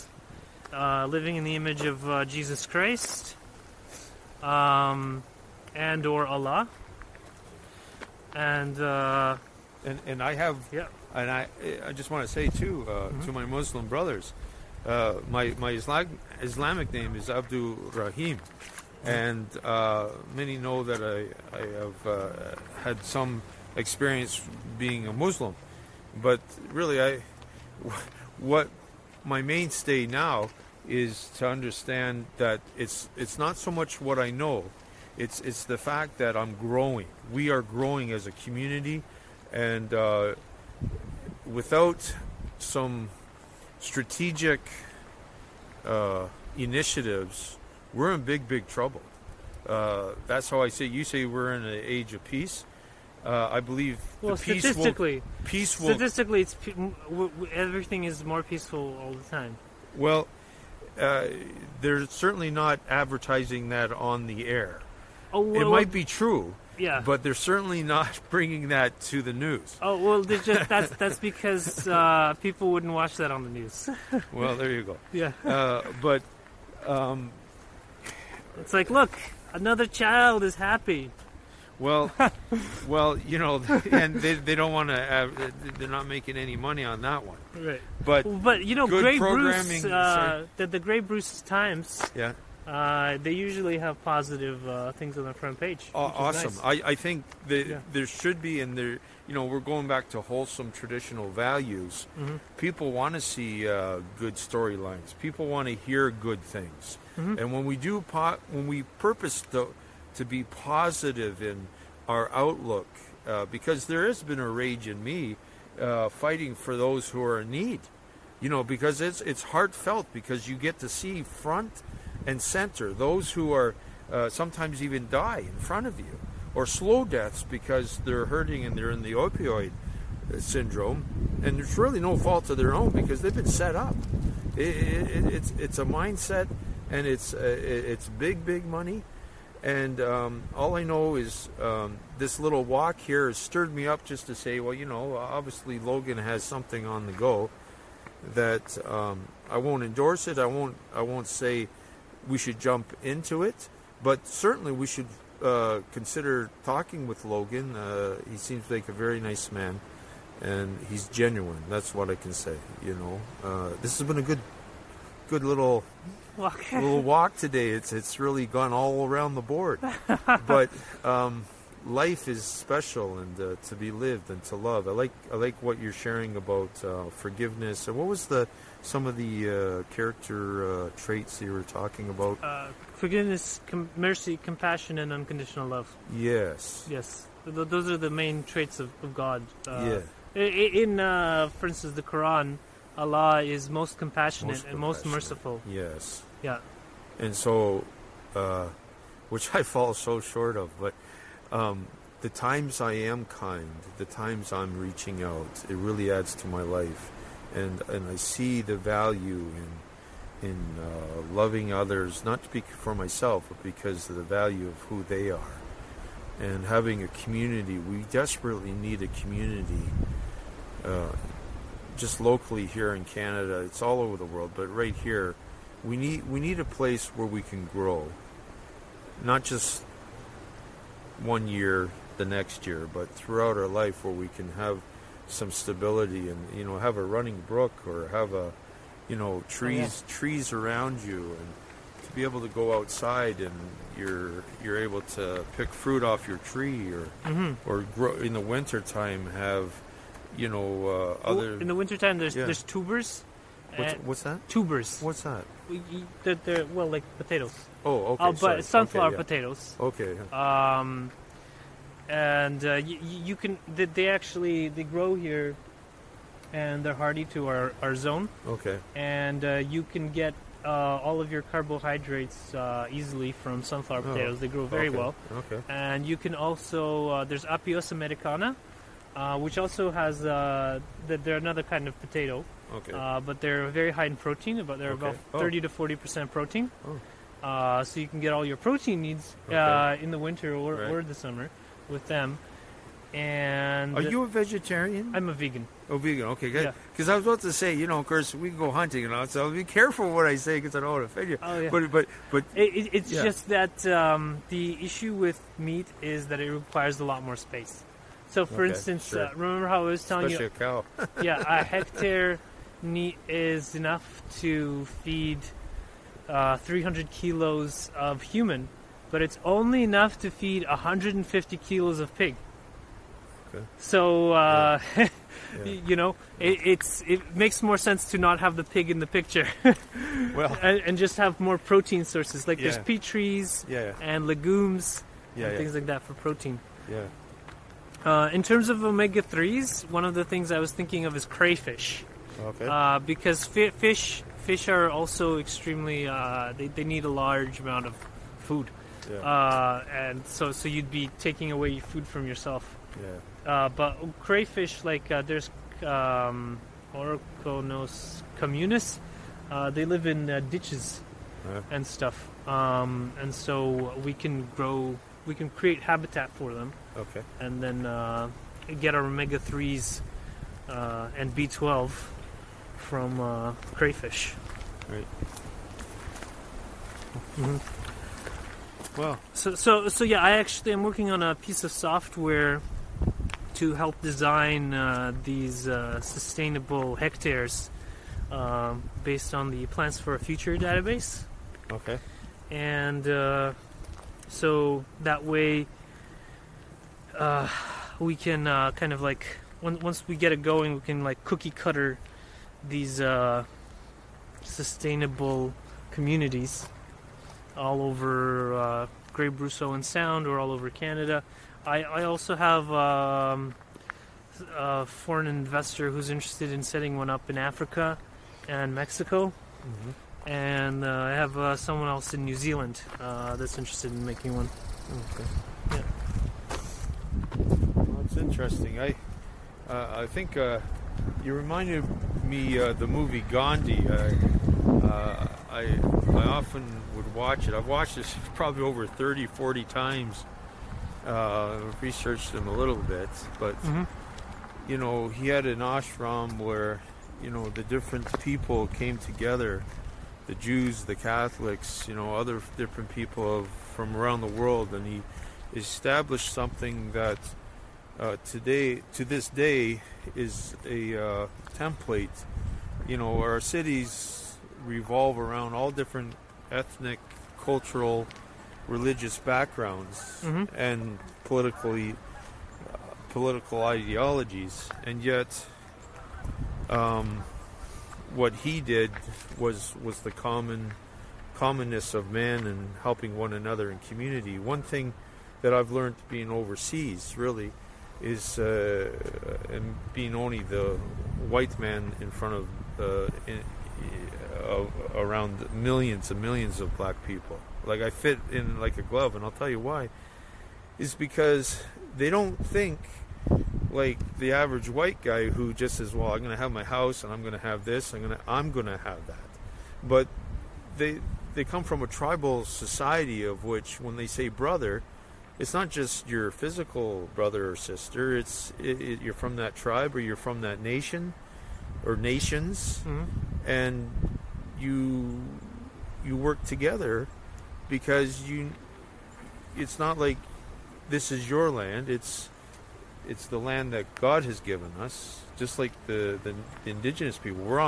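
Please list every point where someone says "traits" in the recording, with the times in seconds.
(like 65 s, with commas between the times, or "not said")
180 s, 188 s.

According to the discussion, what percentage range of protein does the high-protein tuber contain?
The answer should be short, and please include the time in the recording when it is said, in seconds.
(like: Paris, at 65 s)
30 to 40 percent, at 285 s.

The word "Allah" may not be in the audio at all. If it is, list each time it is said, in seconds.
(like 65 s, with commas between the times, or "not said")
6 s, 192 s.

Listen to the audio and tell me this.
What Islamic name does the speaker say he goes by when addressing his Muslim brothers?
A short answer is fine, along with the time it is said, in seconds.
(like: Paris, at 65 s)
Abdul Rahim, at 17 s.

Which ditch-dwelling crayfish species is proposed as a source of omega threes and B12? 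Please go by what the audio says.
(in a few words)
Orconectes immunis.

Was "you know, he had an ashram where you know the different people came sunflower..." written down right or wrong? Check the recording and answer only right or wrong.
wrong.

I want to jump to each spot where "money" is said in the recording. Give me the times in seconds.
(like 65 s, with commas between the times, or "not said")
86 s, 138 s.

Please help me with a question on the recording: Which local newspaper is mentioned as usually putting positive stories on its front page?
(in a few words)
Grey Bruce Times.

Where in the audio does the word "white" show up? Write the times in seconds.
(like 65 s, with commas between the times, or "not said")
491 s, 504 s.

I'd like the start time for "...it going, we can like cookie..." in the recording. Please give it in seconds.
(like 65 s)
400 s.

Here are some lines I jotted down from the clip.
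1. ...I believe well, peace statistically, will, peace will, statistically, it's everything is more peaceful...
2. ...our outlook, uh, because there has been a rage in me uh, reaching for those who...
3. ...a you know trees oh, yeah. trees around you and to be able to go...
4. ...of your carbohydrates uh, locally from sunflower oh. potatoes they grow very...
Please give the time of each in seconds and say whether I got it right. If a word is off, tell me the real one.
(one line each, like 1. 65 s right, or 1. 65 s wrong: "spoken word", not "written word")
1. 53 s right
2. 112 s wrong: "fighting", not "reaching"
3. 238 s right
4. 271 s wrong: "easily", not "locally".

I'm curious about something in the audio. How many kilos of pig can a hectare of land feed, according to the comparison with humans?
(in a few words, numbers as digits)
150 kilos.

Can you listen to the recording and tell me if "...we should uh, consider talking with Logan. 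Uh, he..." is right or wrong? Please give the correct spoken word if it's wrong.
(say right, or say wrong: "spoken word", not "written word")
right.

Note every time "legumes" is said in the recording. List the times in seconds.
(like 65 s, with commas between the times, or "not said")
334 s.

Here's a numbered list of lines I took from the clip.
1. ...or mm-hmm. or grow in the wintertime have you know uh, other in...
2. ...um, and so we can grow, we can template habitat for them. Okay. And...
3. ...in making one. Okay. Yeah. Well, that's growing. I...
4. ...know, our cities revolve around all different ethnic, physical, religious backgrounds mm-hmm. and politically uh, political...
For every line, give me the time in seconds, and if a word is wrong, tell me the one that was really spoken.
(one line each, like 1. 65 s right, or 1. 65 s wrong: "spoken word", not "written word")
1. 246 s right
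2. 362 s wrong: "create", not "template"
3. 423 s wrong: "interesting", not "growing"
4. 462 s wrong: "cultural", not "physical".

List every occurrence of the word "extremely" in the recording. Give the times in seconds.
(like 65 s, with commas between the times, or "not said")
345 s.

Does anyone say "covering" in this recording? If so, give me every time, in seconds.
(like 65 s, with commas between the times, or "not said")
not said.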